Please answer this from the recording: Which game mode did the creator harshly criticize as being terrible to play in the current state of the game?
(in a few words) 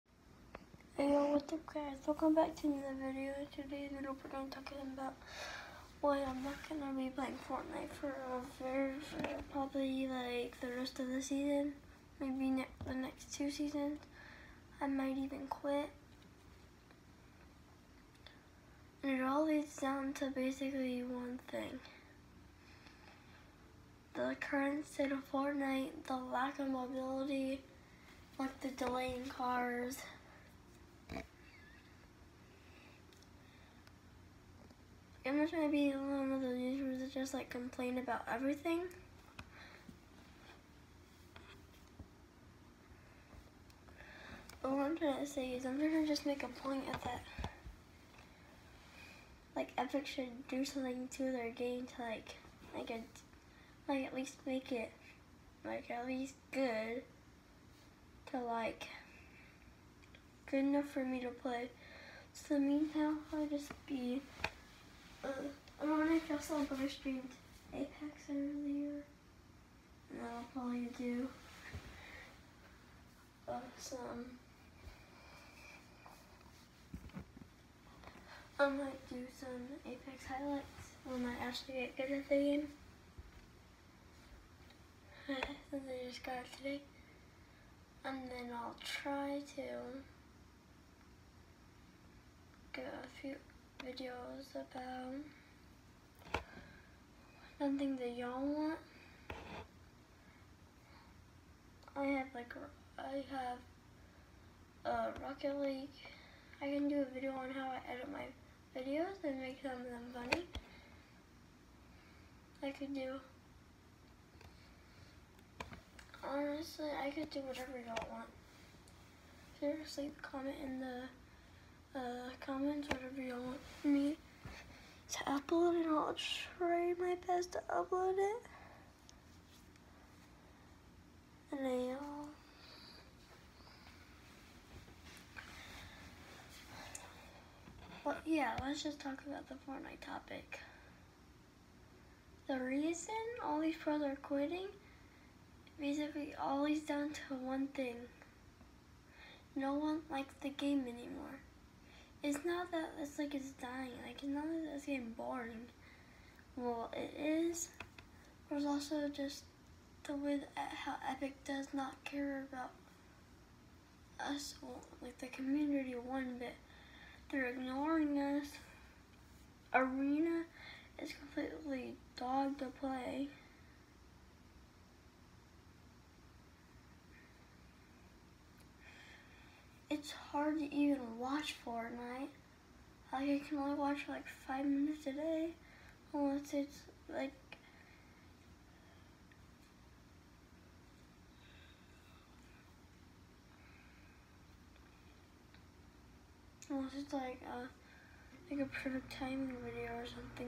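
Arena.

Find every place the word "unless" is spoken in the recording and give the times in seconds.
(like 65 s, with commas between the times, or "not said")
186 s, 196 s.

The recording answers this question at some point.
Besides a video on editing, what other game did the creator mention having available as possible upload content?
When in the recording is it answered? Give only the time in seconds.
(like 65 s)
105 s.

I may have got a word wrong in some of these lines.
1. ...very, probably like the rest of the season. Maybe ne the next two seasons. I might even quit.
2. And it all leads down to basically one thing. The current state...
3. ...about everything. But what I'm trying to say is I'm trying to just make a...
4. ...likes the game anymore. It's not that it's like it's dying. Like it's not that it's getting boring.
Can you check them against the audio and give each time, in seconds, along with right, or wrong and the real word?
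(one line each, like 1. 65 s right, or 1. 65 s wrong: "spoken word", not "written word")
1. 9 s right
2. 19 s right
3. 37 s right
4. 150 s right.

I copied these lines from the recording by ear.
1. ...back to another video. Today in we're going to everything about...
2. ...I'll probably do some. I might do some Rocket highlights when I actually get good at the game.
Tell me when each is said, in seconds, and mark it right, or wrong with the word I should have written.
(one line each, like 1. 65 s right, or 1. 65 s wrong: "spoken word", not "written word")
1. 2 s wrong: "talking", not "everything"
2. 70 s wrong: "Apex", not "Rocket".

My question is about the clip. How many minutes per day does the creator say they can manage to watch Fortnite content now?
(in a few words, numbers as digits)
5.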